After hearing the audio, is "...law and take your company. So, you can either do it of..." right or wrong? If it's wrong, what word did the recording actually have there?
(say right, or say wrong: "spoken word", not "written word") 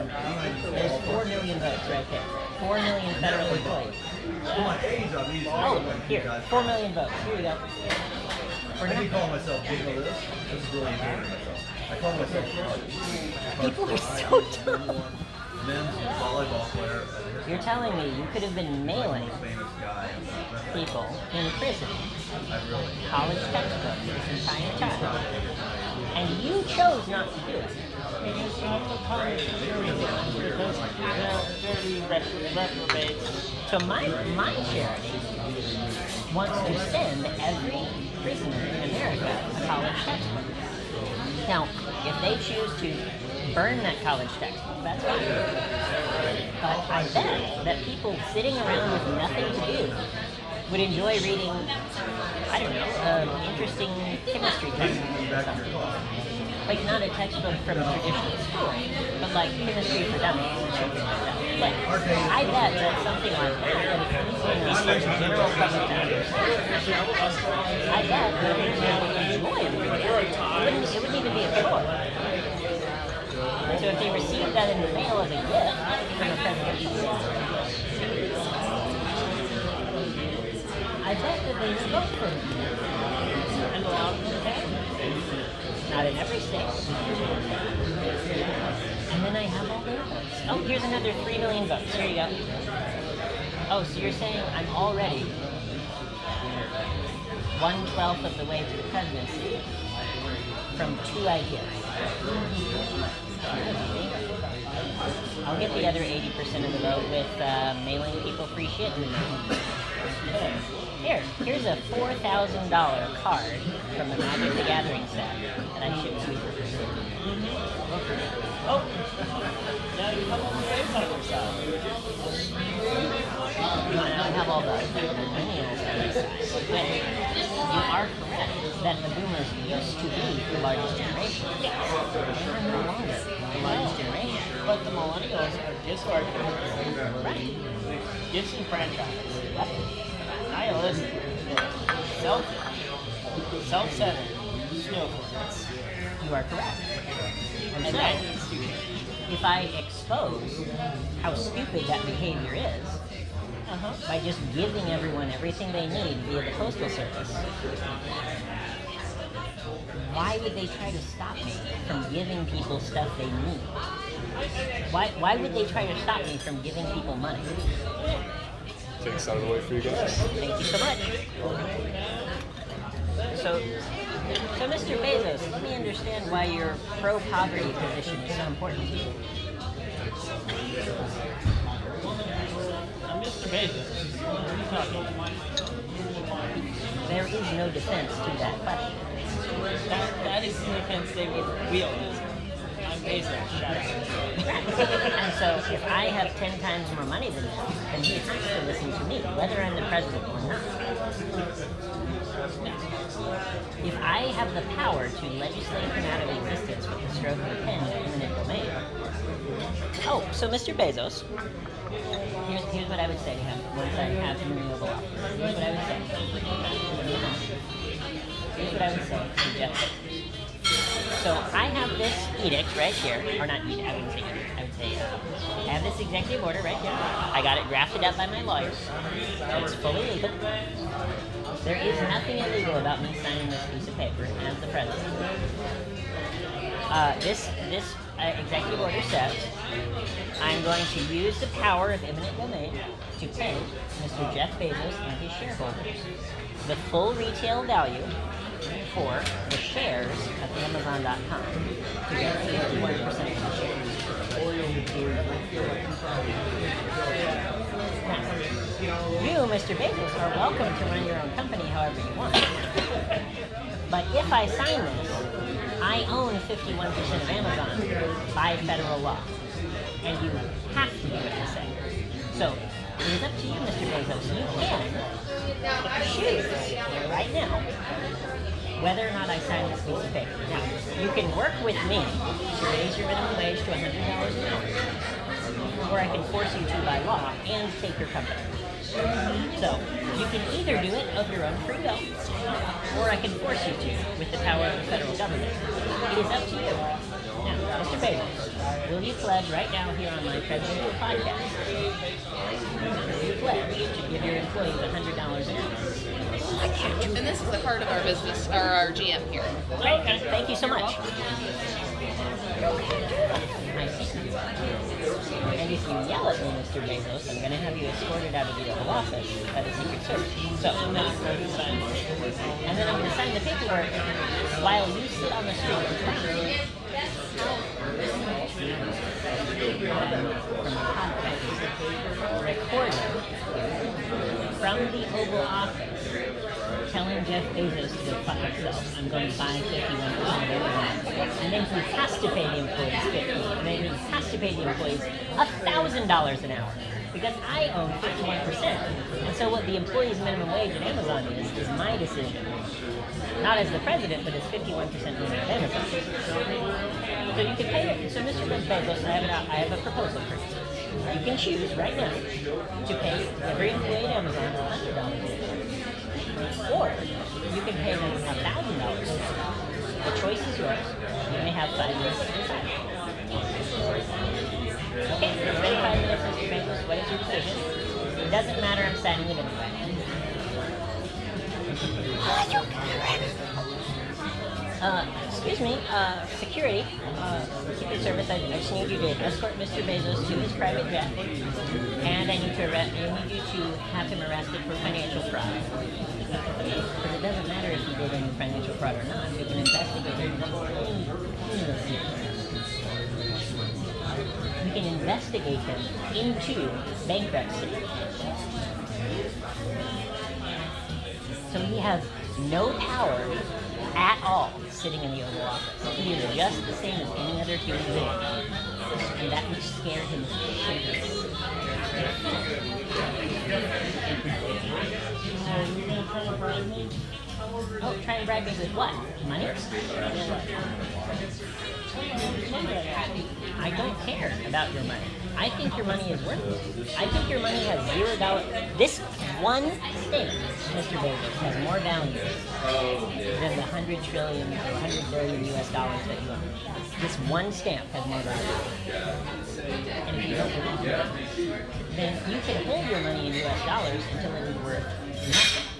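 right.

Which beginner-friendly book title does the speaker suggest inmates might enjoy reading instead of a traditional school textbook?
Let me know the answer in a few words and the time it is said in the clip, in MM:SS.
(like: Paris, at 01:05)
Chemistry for Dummies, at 00:59.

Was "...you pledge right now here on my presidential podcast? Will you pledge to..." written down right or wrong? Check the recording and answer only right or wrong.
right.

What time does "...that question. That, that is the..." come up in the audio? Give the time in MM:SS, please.
03:08.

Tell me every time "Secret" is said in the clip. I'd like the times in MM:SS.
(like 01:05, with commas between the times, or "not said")
05:19, 06:27.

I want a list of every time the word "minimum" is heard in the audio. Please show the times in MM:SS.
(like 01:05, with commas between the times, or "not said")
04:43, 05:50.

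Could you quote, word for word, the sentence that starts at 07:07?
Oh, try and bribe me with what?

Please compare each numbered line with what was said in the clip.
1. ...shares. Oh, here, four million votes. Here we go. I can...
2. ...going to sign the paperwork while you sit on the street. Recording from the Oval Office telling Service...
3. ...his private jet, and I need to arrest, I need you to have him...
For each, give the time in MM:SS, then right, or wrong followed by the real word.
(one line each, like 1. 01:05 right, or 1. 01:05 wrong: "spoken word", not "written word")
1. 00:03 wrong: "employees", not "shares"
2. 05:22 wrong: "Jeff", not "Service"
3. 06:30 right.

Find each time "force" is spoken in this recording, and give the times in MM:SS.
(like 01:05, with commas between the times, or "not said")
04:46, 04:53.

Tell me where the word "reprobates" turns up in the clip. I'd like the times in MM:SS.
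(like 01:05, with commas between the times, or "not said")
00:32.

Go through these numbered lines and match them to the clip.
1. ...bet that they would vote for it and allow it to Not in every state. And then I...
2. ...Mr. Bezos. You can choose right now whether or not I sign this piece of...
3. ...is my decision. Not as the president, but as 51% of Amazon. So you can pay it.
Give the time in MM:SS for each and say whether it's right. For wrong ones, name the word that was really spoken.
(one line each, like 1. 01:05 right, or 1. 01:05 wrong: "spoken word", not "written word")
1. 01:21 right
2. 04:33 right
3. 05:51 right.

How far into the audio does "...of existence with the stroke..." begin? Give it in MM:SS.
03:26.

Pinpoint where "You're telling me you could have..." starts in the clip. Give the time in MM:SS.
00:17.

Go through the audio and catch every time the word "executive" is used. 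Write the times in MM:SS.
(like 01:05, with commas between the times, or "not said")
03:45, 03:58.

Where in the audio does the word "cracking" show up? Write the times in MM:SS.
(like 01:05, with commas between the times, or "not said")
not said.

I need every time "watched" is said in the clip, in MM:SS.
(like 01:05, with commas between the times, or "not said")
not said.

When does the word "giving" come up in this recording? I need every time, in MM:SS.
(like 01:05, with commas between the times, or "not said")
02:34, 02:42, 02:46.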